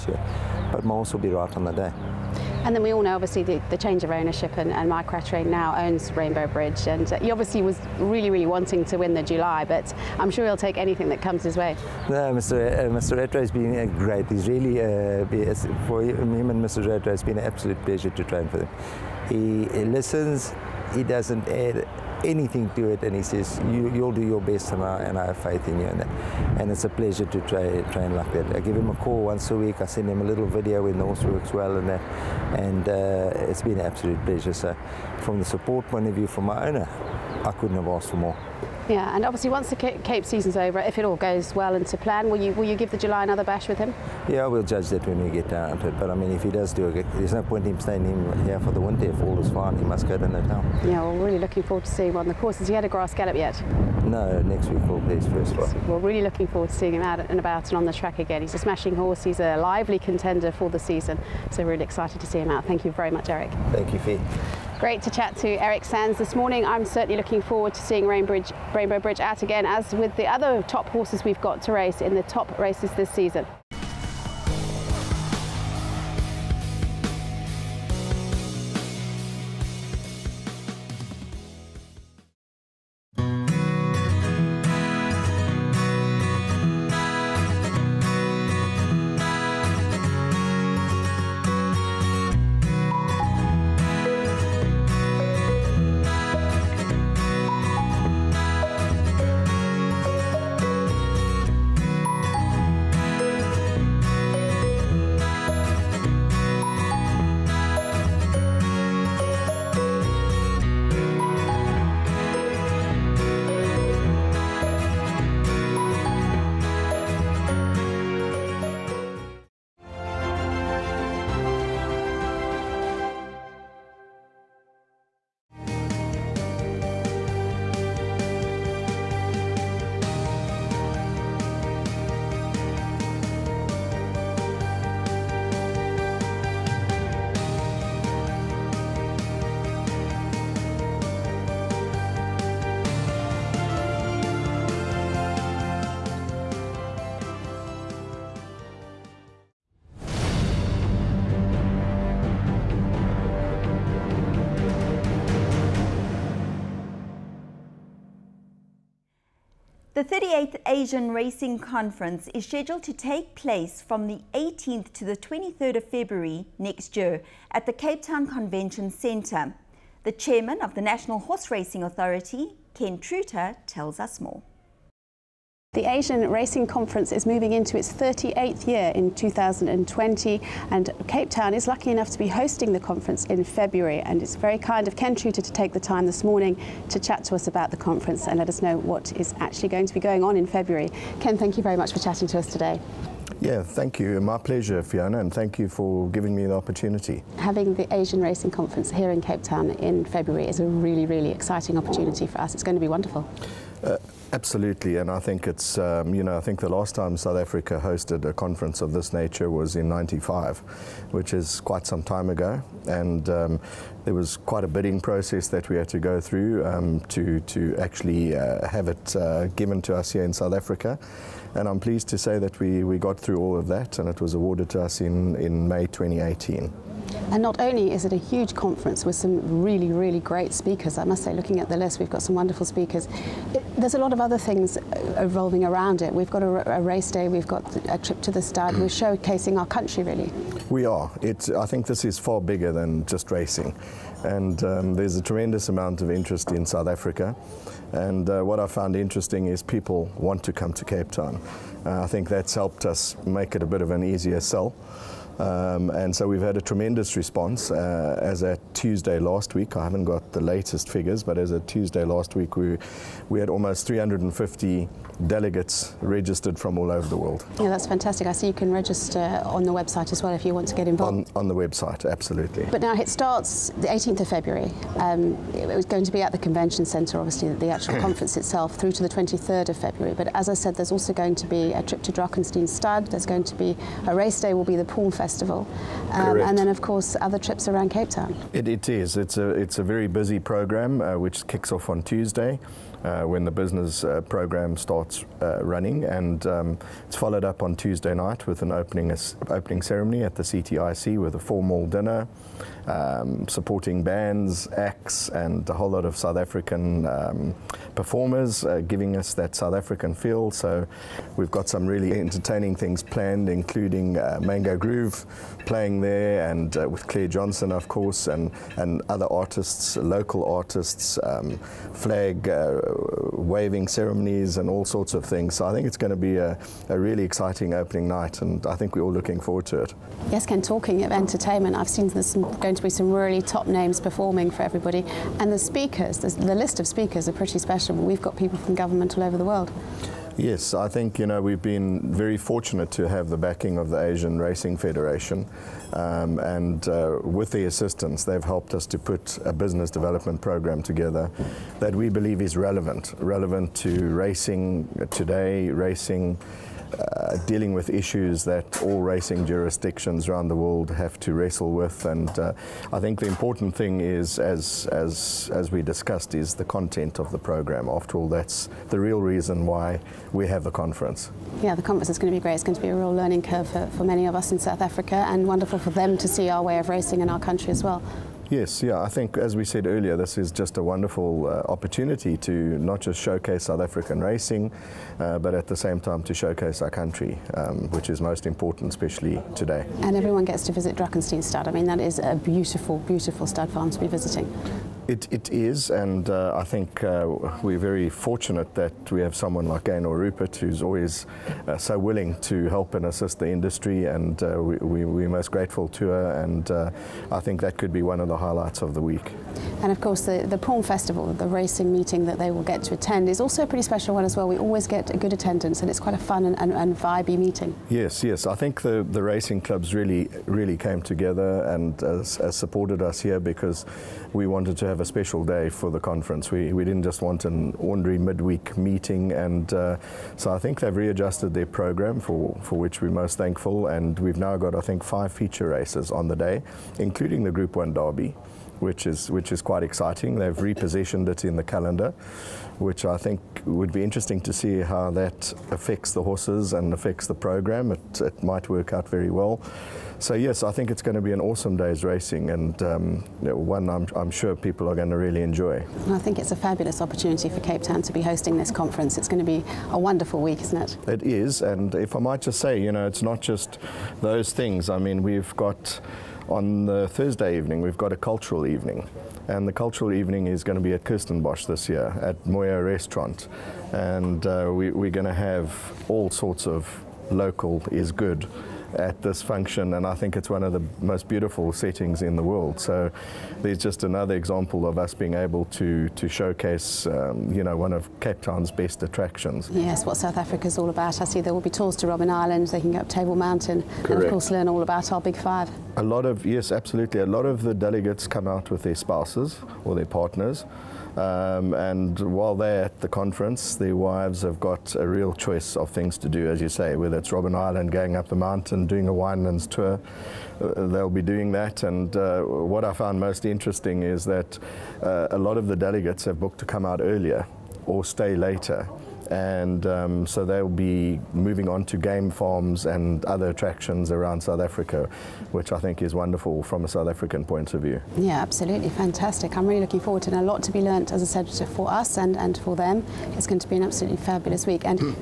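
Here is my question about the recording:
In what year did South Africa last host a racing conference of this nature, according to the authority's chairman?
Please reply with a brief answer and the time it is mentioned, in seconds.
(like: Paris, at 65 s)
1995, at 209 s.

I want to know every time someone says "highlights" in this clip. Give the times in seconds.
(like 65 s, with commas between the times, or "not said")
408 s.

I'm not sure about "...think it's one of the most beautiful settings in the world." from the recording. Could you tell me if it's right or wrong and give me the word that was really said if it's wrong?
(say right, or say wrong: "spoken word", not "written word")
right.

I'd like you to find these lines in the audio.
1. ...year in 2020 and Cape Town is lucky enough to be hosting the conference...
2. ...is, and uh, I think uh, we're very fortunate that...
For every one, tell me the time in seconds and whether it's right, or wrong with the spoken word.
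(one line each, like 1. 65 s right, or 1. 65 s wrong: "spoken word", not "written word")
1. 178 s right
2. 395 s right.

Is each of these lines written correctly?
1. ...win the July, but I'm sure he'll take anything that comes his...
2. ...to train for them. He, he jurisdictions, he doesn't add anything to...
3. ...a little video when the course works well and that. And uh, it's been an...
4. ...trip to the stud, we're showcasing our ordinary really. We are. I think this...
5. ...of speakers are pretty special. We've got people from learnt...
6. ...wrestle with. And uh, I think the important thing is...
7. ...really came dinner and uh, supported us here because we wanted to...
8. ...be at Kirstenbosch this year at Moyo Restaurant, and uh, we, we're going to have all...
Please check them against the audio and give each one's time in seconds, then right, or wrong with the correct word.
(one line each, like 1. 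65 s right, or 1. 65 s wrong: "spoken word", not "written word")
1. 8 s right
2. 18 s wrong: "listens", not "jurisdictions"
3. 30 s wrong: "horse", not "course"
4. 237 s wrong: "country", not "ordinary"
5. 336 s wrong: "government", not "learnt"
6. 361 s right
7. 420 s wrong: "together", not "dinner"
8. 470 s right.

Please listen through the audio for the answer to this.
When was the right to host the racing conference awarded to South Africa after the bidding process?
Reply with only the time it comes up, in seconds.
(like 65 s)
225 s.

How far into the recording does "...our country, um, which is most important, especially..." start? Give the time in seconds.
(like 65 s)
386 s.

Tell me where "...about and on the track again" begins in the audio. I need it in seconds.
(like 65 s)
57 s.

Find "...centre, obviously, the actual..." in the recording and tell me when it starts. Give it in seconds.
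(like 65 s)
276 s.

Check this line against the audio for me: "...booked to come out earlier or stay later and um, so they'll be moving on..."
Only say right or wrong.
right.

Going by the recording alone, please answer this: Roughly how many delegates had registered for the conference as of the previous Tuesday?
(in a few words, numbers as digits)
350.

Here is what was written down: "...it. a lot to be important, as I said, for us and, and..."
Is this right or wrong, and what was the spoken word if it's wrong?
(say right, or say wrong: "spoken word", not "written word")
wrong: "learnt", not "important".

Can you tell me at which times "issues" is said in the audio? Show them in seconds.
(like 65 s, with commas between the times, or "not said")
357 s.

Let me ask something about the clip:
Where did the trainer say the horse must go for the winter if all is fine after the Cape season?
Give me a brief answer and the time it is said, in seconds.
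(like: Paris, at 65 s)
Natal, at 50 s.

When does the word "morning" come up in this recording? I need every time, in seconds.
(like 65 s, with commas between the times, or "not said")
66 s, 186 s.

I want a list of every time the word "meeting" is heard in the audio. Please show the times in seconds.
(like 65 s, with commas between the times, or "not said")
411 s, 417 s, 428 s.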